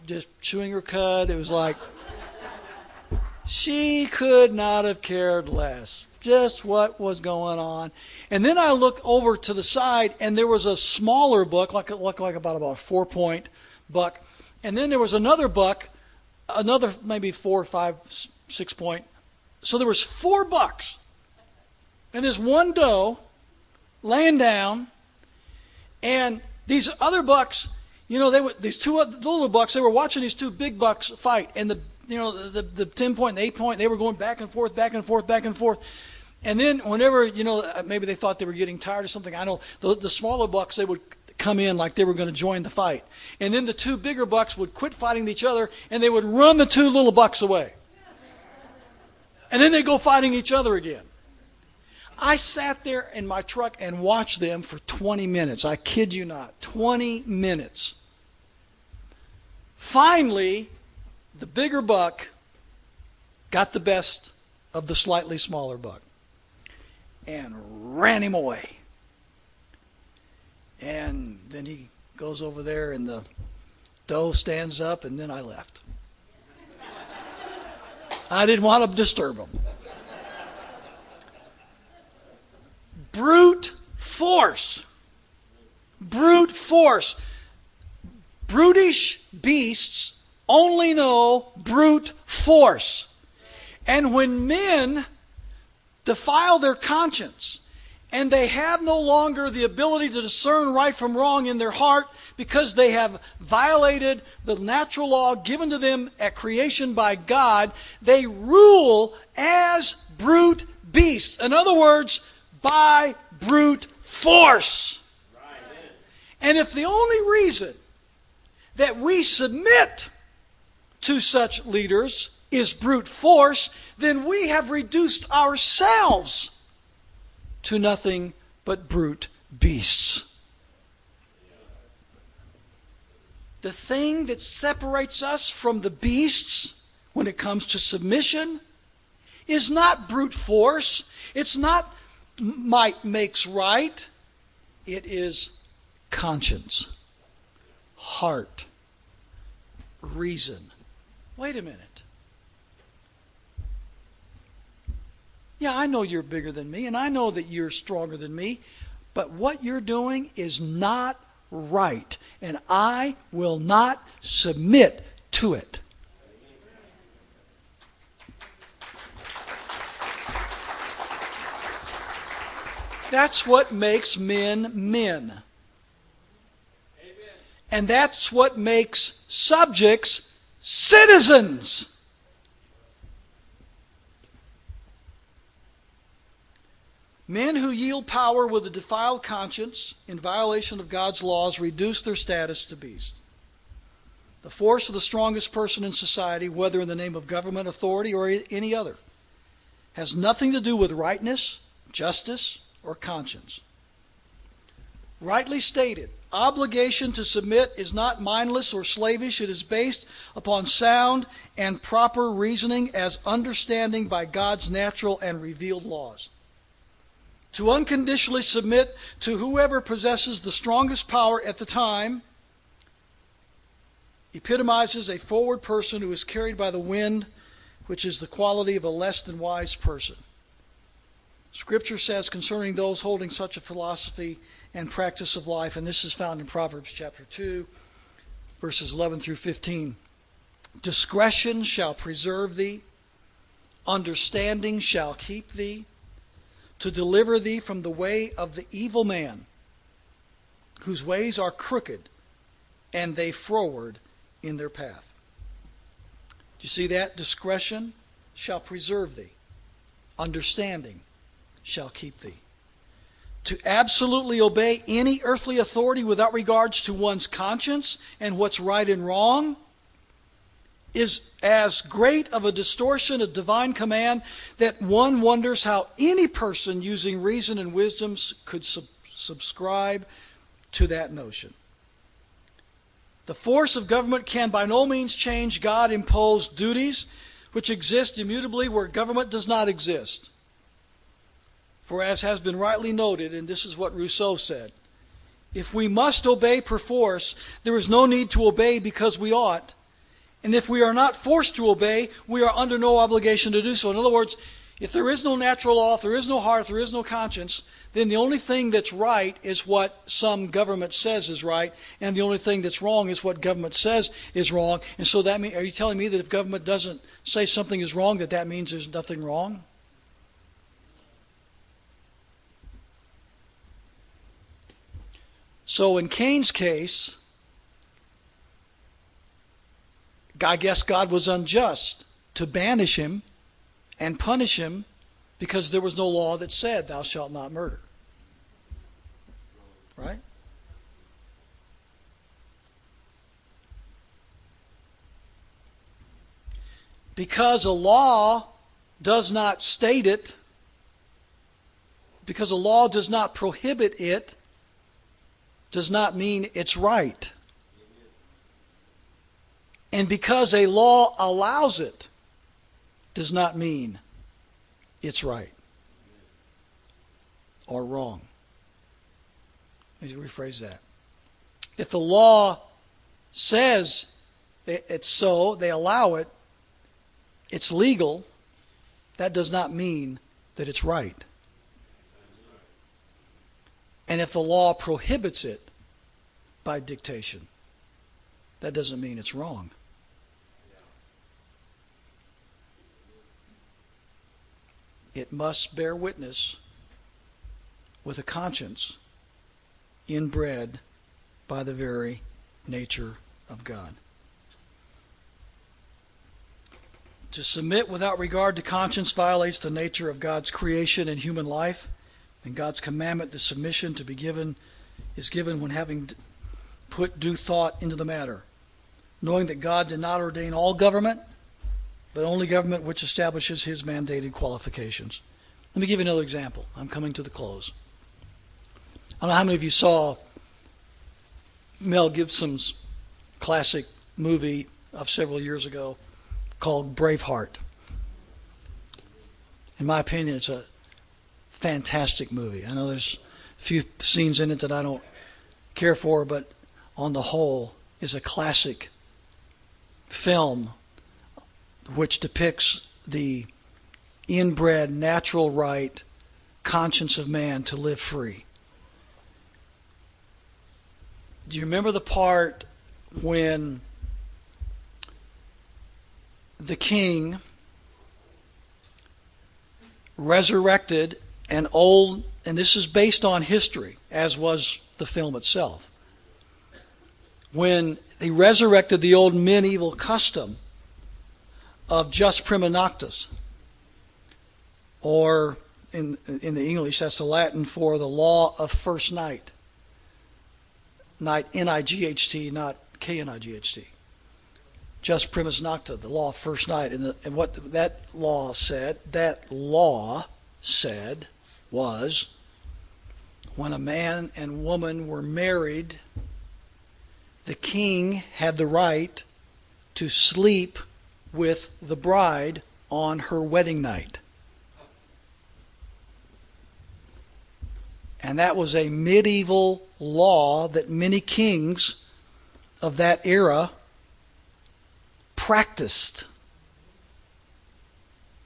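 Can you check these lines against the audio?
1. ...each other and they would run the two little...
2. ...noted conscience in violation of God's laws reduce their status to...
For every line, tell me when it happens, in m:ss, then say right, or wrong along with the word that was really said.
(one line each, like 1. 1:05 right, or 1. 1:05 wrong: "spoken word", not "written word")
1. 0:45 right
2. 3:08 wrong: "defiled", not "noted".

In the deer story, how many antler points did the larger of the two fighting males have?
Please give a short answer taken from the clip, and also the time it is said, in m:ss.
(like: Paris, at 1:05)
10, at 0:32.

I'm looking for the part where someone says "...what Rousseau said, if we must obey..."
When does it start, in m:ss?
4:53.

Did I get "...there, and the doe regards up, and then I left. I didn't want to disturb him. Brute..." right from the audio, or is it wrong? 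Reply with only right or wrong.
wrong.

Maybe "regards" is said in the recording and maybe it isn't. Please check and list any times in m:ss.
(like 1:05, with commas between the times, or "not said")
4:26, 6:48.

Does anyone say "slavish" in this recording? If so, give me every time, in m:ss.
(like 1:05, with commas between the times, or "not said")
3:28.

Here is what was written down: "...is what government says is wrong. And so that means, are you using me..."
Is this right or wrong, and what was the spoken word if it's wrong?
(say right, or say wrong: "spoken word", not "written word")
wrong: "telling", not "using".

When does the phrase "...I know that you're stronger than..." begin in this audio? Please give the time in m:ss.
2:36.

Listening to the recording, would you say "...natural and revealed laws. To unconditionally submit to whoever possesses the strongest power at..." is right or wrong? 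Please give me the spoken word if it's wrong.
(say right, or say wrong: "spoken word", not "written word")
right.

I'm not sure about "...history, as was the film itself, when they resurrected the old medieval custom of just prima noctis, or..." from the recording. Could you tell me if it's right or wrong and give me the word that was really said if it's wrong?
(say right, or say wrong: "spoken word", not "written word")
right.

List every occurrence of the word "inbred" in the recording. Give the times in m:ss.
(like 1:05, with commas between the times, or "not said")
6:40, 7:34.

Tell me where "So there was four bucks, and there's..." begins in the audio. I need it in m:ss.
0:19.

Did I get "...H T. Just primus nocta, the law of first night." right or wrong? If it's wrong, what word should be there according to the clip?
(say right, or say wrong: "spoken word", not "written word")
right.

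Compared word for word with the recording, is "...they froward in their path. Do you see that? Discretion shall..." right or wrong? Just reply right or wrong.
right.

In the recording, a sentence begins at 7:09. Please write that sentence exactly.
I don't know how many of you saw Mel Gibson's classic movie of several years ago called Braveheart.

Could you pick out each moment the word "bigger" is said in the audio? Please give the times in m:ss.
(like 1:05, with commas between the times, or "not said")
0:43, 1:01, 2:36.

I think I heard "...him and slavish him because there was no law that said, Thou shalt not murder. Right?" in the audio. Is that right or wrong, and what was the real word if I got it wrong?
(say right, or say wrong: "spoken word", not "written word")
wrong: "punish", not "slavish".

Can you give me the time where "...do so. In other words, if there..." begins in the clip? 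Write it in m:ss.
5:03.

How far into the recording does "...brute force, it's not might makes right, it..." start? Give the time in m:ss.
2:20.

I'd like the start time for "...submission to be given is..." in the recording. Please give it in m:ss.
6:53.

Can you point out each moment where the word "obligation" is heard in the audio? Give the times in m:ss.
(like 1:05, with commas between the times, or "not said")
3:26, 5:02.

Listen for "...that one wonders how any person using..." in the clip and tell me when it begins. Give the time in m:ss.
4:34.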